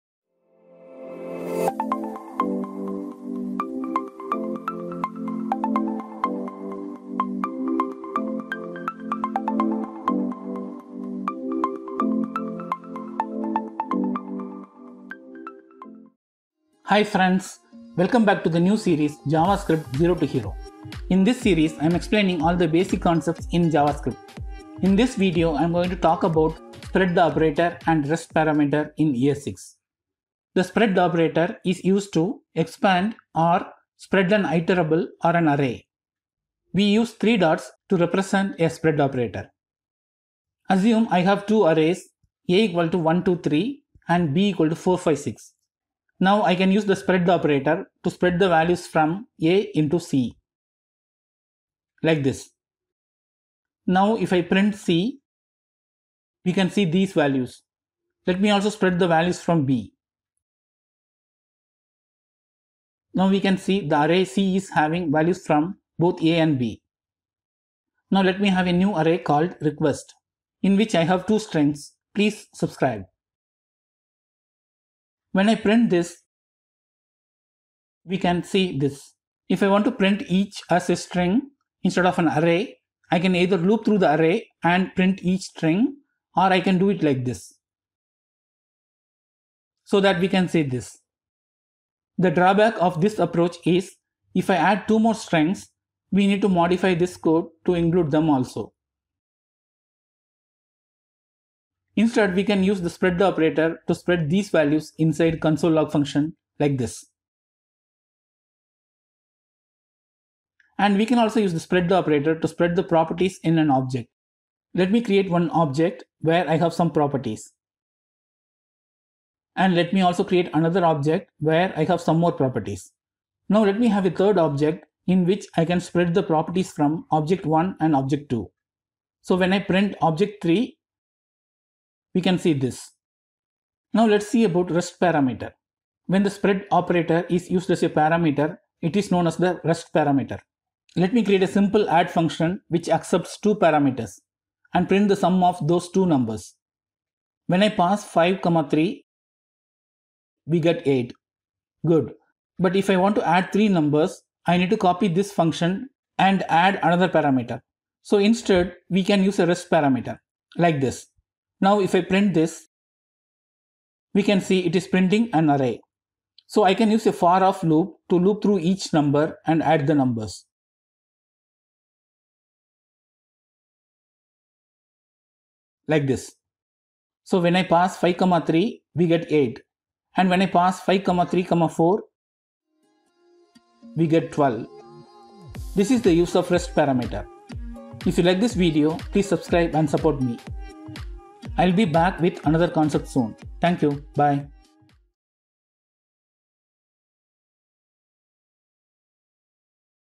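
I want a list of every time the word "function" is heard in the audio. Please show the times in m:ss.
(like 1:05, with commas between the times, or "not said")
1:45, 2:22, 2:35.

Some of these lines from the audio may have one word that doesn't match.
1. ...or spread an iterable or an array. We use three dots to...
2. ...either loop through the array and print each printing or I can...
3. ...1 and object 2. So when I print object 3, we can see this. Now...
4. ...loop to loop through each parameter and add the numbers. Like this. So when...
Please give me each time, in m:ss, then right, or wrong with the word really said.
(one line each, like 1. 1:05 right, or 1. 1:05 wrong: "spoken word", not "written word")
1. 0:33 right
2. 1:23 wrong: "string", not "printing"
3. 2:07 right
4. 2:47 wrong: "number", not "parameter".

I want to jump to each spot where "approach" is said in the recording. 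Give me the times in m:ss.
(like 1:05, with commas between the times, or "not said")
1:33.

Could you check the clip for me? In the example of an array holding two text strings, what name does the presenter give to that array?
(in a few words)
request.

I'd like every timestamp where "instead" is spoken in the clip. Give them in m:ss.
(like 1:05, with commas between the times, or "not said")
1:21, 1:42, 2:38.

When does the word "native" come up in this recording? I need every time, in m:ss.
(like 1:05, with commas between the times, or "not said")
not said.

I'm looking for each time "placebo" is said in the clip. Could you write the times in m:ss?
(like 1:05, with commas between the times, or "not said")
not said.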